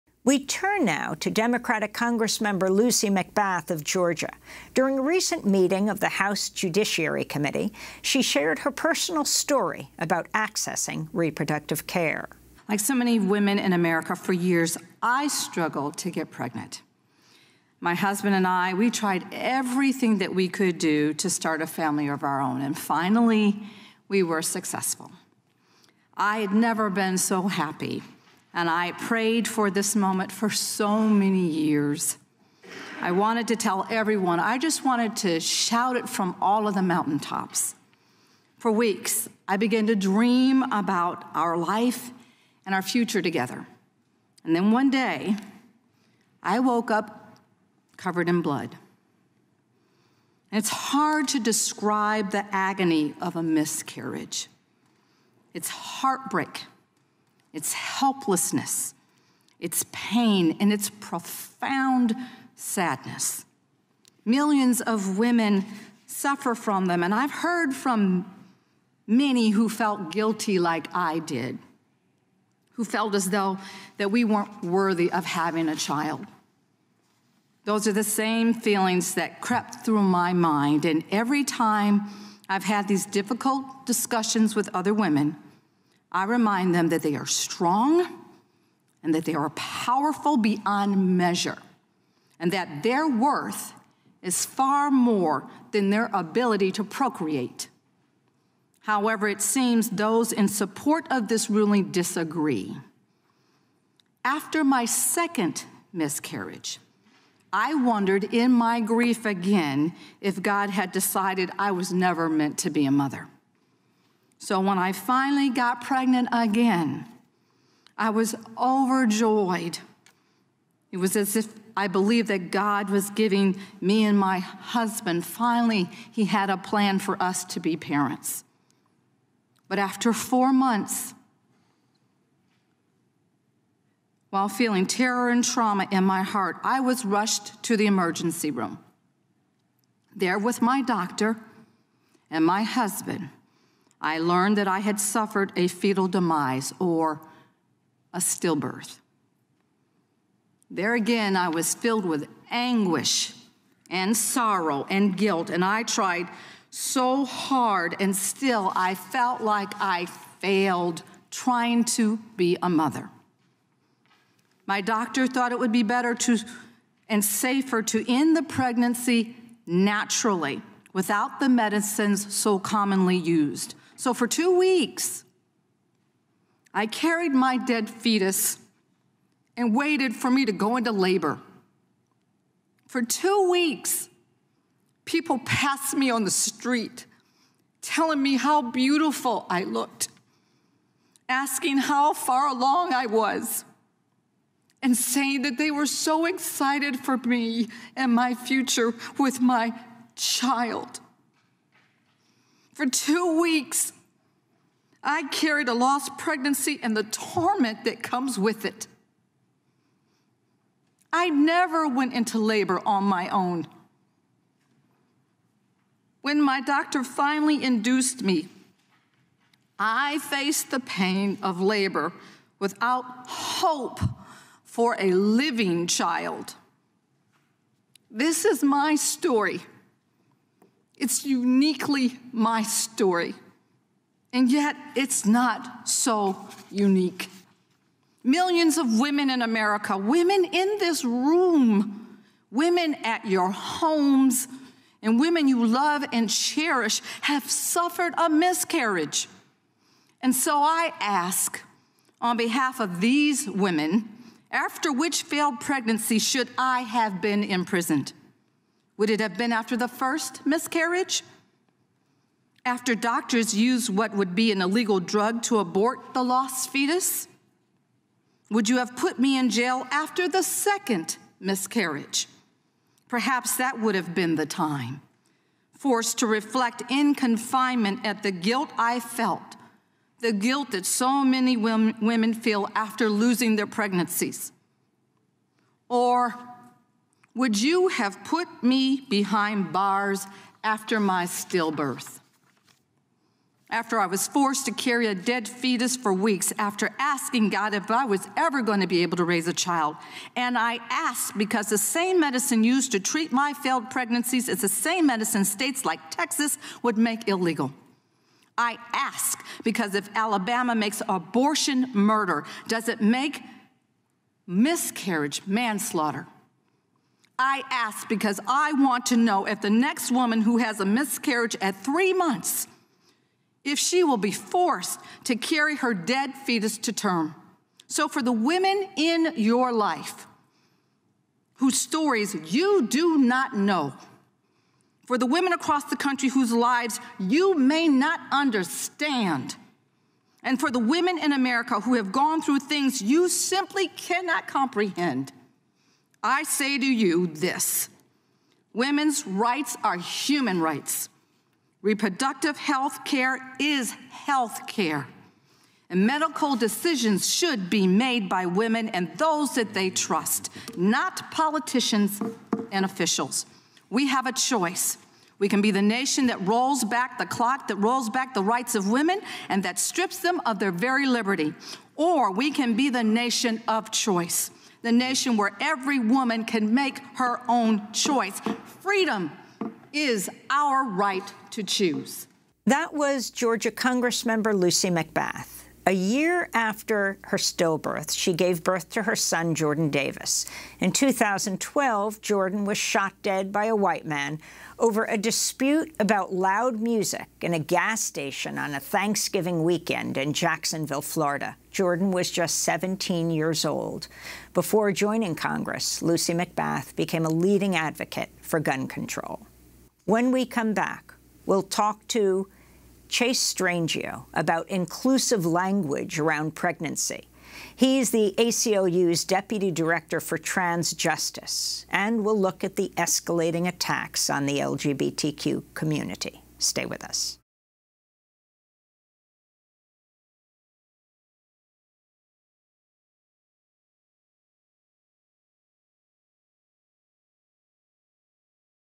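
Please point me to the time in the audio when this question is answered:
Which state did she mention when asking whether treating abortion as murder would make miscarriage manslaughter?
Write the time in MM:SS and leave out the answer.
05:10.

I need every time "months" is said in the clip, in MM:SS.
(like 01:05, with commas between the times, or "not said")
02:10, 05:22.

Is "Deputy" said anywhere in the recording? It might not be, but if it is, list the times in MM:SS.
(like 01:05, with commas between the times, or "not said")
06:59.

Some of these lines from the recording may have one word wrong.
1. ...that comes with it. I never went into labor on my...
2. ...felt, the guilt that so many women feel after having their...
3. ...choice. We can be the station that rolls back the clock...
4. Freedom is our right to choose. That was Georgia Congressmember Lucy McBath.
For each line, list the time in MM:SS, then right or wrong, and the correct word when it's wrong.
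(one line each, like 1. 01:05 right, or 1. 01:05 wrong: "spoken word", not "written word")
1. 03:27 right
2. 04:38 wrong: "losing", not "having"
3. 06:04 wrong: "nation", not "station"
4. 06:18 right.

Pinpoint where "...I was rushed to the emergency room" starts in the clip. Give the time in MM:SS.
02:16.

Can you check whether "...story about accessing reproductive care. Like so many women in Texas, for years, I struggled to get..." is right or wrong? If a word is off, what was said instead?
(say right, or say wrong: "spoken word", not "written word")
wrong: "America", not "Texas".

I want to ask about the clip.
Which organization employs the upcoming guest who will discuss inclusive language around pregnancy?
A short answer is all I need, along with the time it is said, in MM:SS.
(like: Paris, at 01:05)
ACLU, at 06:58.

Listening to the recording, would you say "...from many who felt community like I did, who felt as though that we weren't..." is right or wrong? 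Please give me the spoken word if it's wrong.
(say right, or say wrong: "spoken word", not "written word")
wrong: "guilty", not "community".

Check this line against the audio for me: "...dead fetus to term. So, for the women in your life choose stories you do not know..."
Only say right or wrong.
wrong.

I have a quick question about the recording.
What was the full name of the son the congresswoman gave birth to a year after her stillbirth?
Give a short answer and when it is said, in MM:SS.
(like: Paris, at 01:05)
Jordan Davis, at 06:29.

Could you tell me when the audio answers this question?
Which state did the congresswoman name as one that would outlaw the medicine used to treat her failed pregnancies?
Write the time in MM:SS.
05:06.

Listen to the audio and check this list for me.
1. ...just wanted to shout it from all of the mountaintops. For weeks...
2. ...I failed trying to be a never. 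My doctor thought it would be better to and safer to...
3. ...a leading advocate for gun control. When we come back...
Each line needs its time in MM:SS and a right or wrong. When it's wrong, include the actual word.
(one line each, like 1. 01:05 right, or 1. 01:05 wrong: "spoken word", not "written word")
1. 00:34 right
2. 02:39 wrong: "mother", not "never"
3. 06:47 right.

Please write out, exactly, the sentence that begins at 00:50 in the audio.
And it's hard to describe the agony of a miscarriage.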